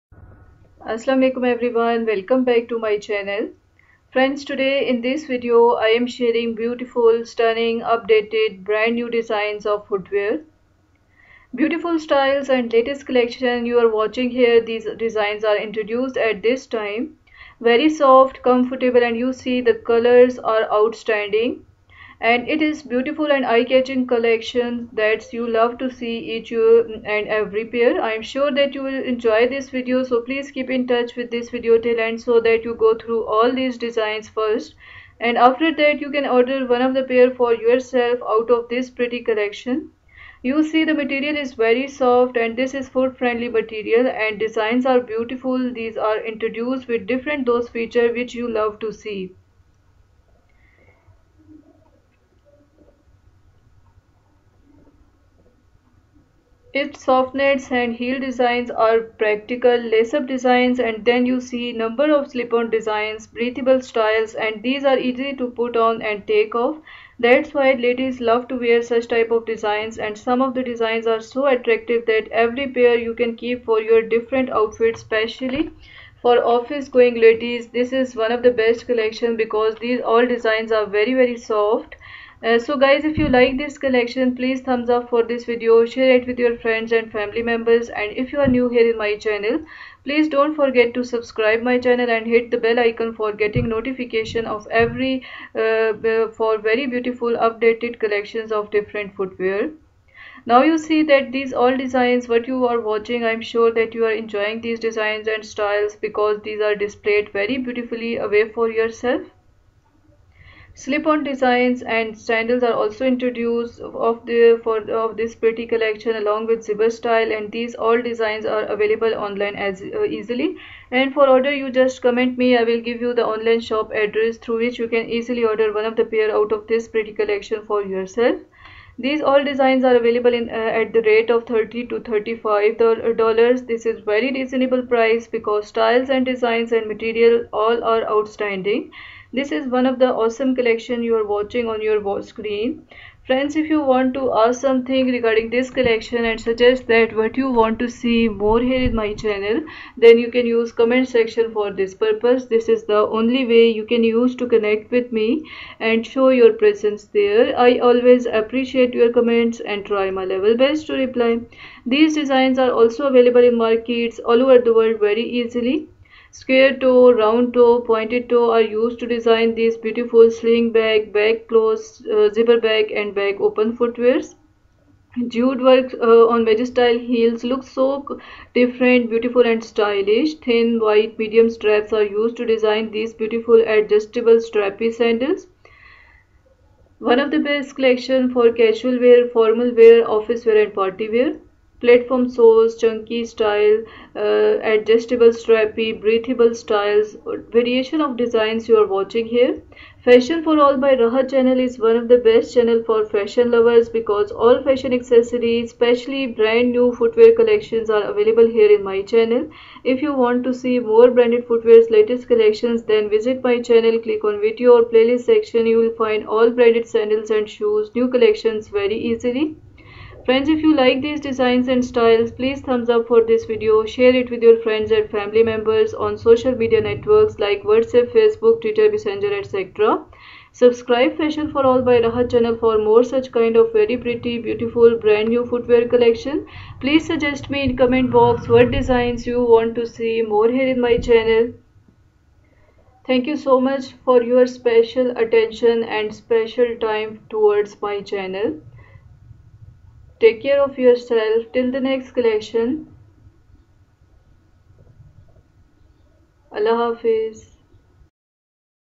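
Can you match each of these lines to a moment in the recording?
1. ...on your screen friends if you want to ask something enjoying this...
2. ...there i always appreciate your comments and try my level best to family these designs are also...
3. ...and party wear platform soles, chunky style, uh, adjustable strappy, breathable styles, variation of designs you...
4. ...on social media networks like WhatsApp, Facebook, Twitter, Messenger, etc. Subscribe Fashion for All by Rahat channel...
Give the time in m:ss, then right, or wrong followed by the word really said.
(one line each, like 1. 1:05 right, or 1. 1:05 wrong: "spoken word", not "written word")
1. 2:21 wrong: "regarding", not "enjoying"
2. 2:37 wrong: "reply", not "family"
3. 3:10 right
4. 3:45 right.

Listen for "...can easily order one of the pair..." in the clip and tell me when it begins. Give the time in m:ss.
2:04.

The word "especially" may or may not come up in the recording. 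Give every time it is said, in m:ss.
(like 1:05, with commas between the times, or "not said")
1:15, 3:25.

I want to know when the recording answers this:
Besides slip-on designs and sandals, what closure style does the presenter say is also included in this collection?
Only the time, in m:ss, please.
1:56.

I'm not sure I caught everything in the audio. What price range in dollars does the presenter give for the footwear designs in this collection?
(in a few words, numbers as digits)
30 to 35 dollars.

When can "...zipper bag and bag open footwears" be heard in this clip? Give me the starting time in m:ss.
2:52.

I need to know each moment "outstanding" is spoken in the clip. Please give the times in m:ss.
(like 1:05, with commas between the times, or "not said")
0:20, 2:18.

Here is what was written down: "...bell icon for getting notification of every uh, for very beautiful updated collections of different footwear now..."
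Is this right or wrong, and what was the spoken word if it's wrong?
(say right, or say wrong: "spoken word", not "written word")
right.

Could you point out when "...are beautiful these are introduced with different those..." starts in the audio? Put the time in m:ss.
0:44.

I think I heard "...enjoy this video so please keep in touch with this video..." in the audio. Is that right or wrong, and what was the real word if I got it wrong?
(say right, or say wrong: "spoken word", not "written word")
right.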